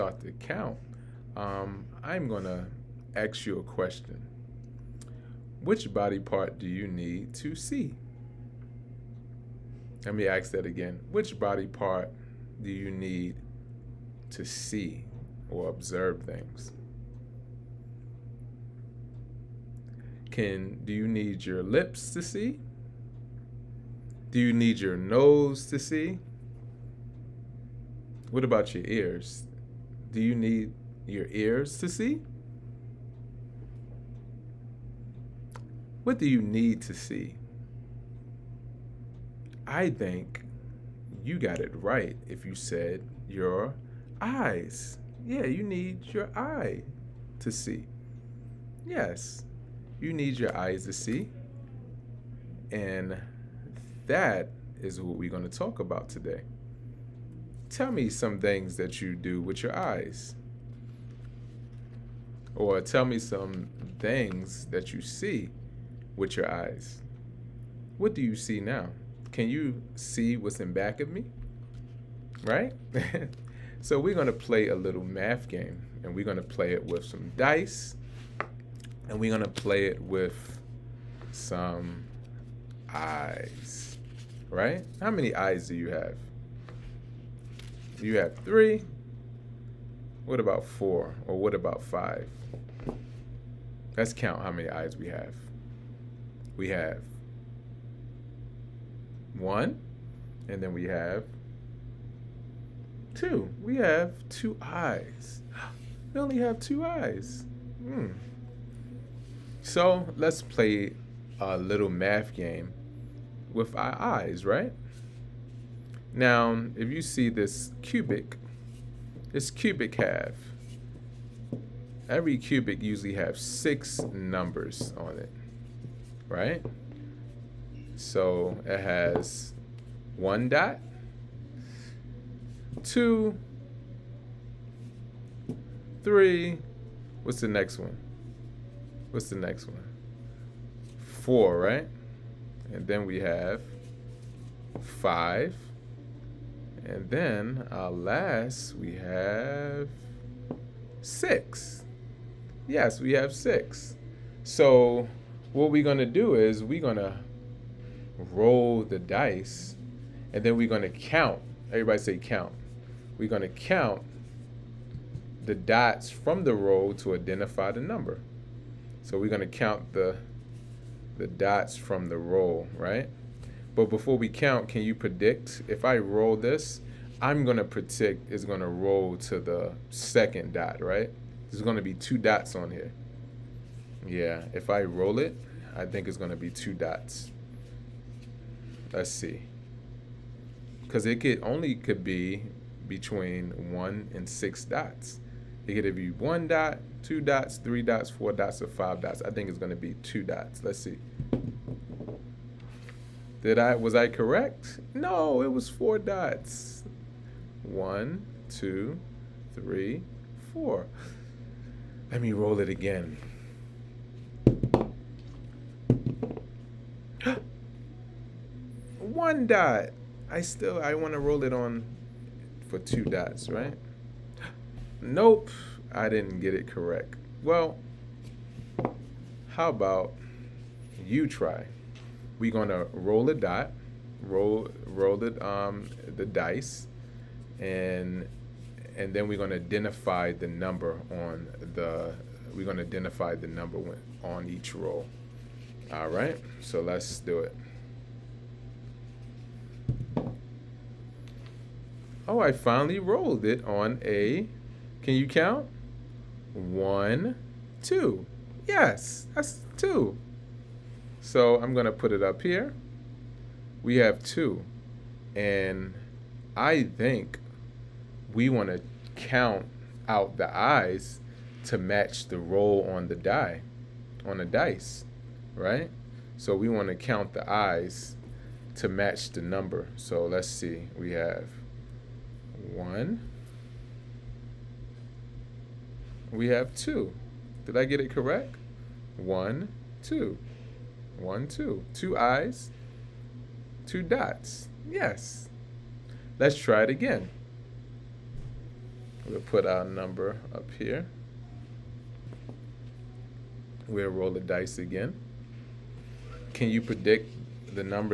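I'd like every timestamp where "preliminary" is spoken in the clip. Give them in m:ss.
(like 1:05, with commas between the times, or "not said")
not said.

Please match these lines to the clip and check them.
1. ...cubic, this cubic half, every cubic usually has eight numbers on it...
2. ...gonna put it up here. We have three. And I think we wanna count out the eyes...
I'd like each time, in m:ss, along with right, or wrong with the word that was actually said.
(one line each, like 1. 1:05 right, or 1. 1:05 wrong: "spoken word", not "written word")
1. 1:57 wrong: "six", not "eight"
2. 4:21 wrong: "two", not "three".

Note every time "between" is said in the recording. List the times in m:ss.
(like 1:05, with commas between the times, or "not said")
3:12.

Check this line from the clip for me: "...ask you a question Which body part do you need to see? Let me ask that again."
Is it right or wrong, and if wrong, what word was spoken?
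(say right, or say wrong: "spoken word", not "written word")
right.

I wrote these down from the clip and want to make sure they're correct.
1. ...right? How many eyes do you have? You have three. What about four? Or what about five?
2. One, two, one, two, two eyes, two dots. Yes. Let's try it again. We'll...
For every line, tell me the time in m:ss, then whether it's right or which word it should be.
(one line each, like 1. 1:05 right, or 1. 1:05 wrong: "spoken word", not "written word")
1. 1:24 right
2. 4:49 right.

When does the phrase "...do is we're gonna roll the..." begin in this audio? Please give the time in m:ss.
2:36.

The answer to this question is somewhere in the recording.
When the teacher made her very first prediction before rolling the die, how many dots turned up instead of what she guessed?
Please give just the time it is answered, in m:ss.
3:25.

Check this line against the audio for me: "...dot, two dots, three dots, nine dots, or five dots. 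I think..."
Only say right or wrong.
wrong.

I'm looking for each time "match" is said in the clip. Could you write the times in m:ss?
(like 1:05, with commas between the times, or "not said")
4:31, 4:38.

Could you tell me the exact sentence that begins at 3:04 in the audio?
Yeah, if I roll it, I think it's going to be two dots.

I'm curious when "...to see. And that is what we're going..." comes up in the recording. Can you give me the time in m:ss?
0:50.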